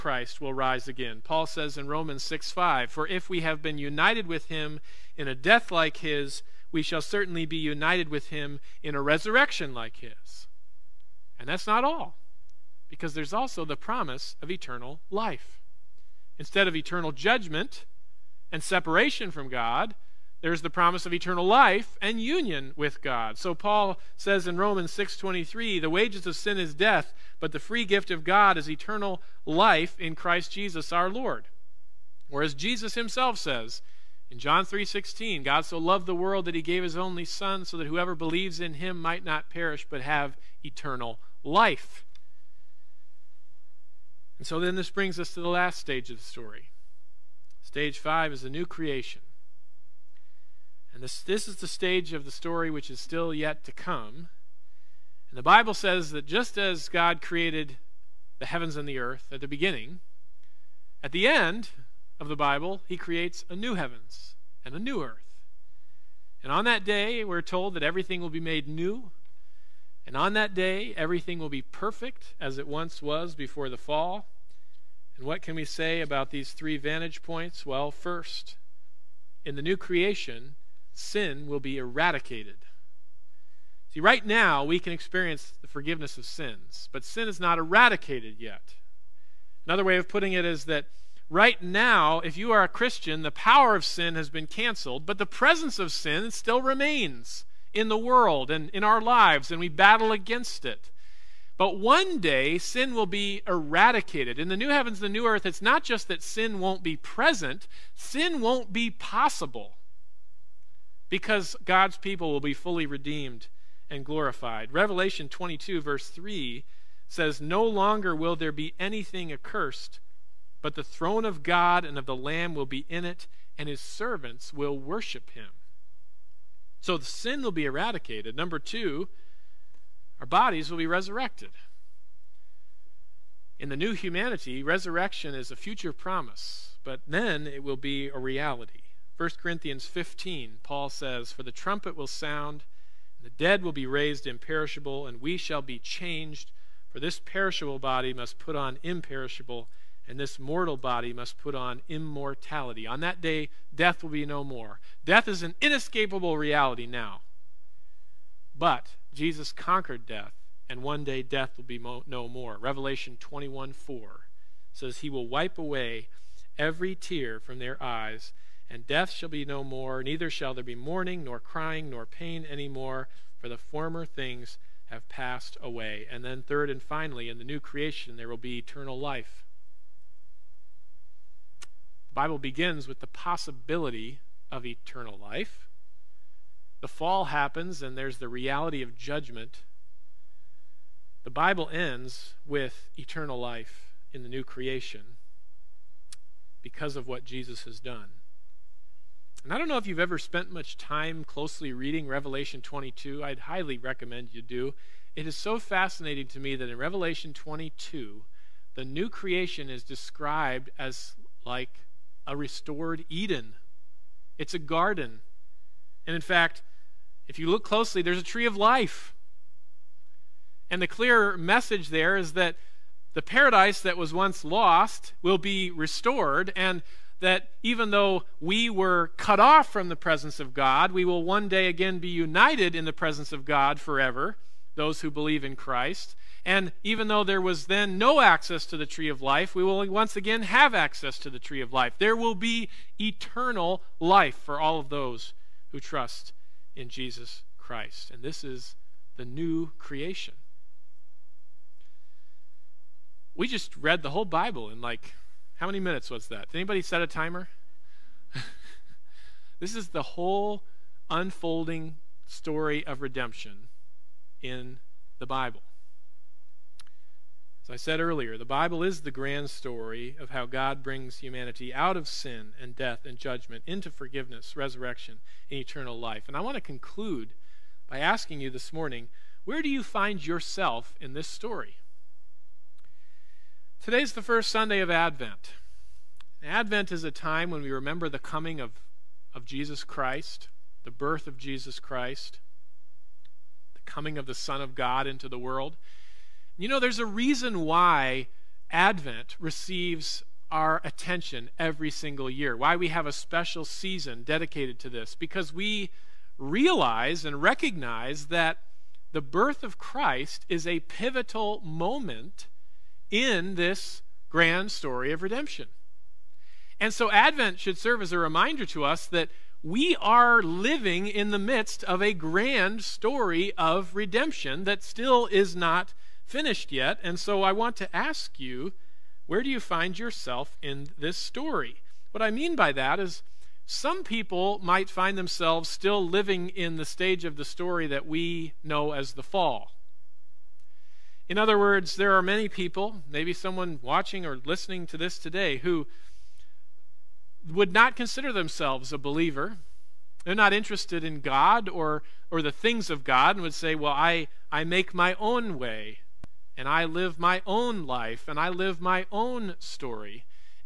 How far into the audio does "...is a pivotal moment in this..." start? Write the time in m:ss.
5:10.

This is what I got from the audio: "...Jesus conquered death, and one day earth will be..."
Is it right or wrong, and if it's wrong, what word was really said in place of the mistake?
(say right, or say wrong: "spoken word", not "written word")
wrong: "death", not "earth".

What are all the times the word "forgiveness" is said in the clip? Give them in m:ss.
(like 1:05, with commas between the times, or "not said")
1:25, 4:33.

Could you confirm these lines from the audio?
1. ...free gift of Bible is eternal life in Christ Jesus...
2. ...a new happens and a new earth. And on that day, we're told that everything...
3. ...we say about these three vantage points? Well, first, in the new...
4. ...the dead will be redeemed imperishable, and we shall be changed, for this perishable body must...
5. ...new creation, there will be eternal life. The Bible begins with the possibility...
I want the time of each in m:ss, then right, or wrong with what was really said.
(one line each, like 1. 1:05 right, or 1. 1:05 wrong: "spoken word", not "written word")
1. 0:27 wrong: "God", not "Bible"
2. 1:03 wrong: "heavens", not "happens"
3. 1:15 right
4. 2:23 wrong: "raised", not "redeemed"
5. 2:57 right.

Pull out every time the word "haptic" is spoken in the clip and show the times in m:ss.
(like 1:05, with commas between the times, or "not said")
not said.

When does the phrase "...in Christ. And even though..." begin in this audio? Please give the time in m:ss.
3:55.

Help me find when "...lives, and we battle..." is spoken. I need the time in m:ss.
1:39.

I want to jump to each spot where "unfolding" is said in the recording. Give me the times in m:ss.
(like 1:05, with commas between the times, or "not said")
4:21.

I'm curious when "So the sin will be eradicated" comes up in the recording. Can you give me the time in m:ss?
2:06.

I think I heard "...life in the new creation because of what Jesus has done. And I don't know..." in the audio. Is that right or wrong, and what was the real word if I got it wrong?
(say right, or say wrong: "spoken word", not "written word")
right.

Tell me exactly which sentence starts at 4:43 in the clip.
Today's the first Sunday of Advent.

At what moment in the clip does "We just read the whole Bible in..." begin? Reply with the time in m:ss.
4:13.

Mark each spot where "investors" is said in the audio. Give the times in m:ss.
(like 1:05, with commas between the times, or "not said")
not said.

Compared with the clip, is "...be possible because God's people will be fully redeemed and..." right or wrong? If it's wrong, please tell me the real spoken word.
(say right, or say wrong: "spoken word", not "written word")
right.